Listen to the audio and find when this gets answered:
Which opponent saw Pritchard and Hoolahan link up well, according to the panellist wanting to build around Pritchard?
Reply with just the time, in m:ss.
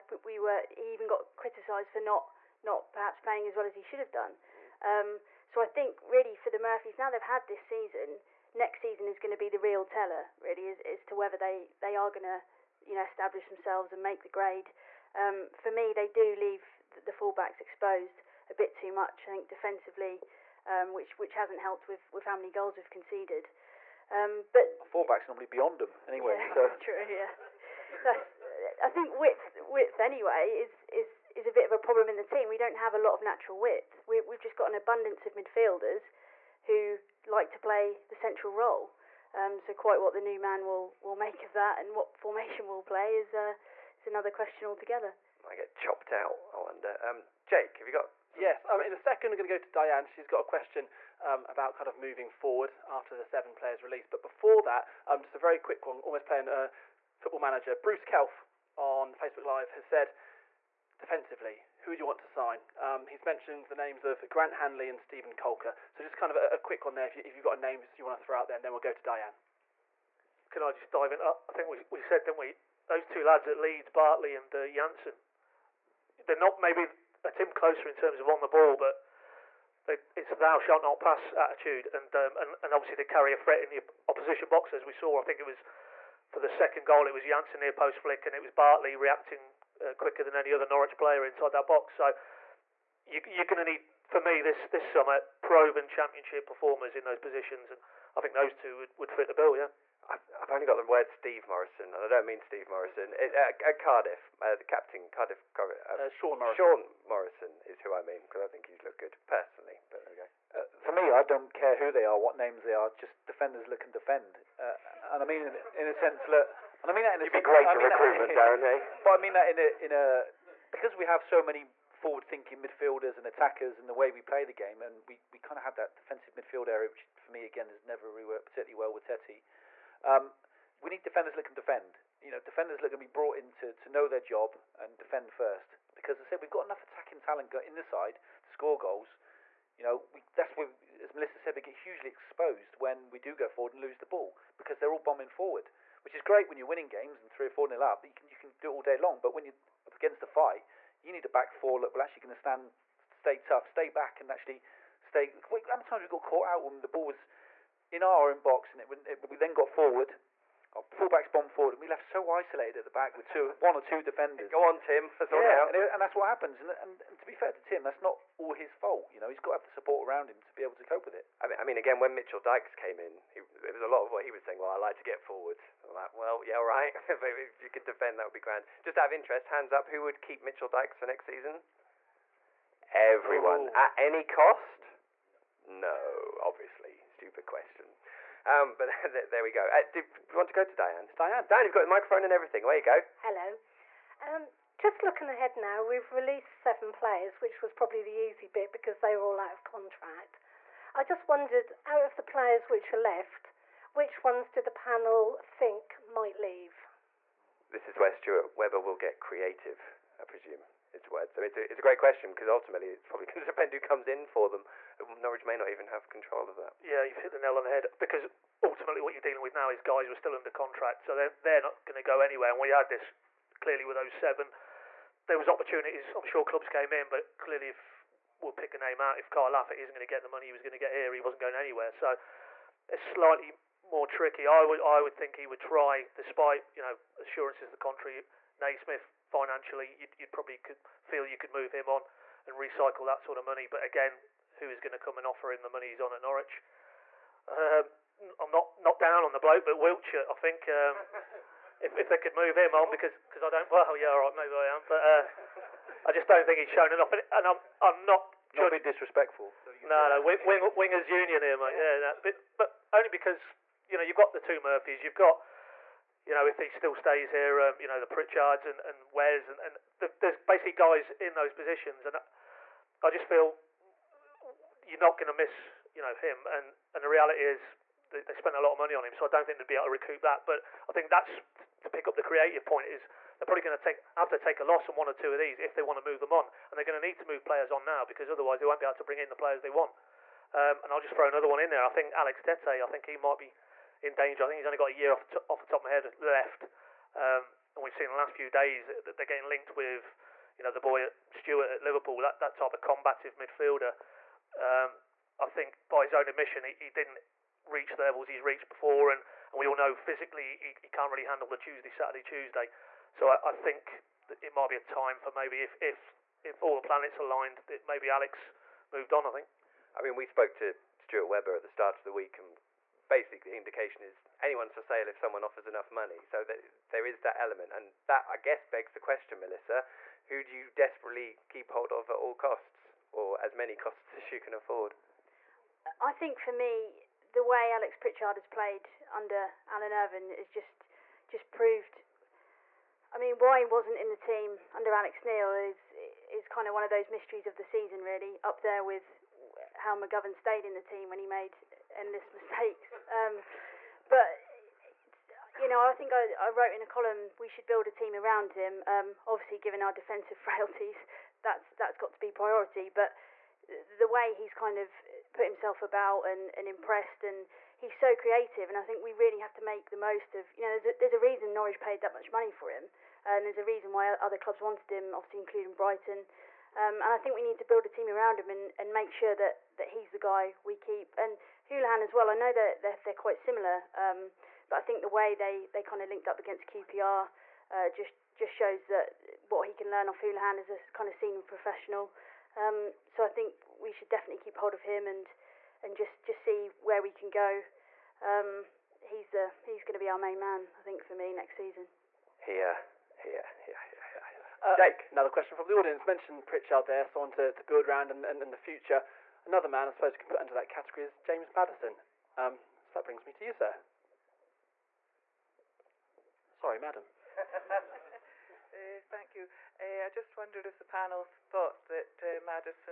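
6:26.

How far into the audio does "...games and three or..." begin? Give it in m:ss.
2:26.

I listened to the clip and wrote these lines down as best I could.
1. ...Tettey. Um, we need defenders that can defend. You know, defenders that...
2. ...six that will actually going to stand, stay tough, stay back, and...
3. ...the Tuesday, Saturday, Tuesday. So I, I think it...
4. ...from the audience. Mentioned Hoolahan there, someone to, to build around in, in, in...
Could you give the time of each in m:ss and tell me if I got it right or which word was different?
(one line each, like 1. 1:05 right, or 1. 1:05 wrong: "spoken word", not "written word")
1. 2:09 right
2. 2:31 wrong: "four", not "six"
3. 5:11 right
4. 6:45 wrong: "Pritchard", not "Hoolahan".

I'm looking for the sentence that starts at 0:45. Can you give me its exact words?
I get chopped out, I wonder.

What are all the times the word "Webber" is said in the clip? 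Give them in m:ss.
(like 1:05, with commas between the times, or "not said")
3:28, 5:21.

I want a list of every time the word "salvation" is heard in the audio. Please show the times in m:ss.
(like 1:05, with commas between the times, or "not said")
not said.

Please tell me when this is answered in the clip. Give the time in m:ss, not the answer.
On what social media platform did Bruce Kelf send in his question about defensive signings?
0:59.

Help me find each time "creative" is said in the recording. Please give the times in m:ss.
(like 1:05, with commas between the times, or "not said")
3:29, 4:42, 6:08.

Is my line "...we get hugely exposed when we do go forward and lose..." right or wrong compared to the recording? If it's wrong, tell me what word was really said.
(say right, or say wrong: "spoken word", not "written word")
right.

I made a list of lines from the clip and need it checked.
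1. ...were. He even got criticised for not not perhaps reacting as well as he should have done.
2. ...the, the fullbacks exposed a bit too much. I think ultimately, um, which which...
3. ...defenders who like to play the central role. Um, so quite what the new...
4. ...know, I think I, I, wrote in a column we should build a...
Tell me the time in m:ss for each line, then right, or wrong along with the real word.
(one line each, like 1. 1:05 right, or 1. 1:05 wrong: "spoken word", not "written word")
1. 0:00 wrong: "playing", not "reacting"
2. 0:16 wrong: "defensively", not "ultimately"
3. 0:35 wrong: "midfielders", not "defenders"
4. 5:55 right.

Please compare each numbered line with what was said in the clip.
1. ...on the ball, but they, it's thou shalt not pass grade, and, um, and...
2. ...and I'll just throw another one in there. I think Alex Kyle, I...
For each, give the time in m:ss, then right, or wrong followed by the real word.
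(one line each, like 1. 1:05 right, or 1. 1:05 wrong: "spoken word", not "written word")
1. 1:18 wrong: "attitude", not "grade"
2. 4:50 wrong: "Tettey", not "Kyle".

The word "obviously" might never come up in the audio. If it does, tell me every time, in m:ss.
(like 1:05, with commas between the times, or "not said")
1:22, 3:06, 5:59, 6:15.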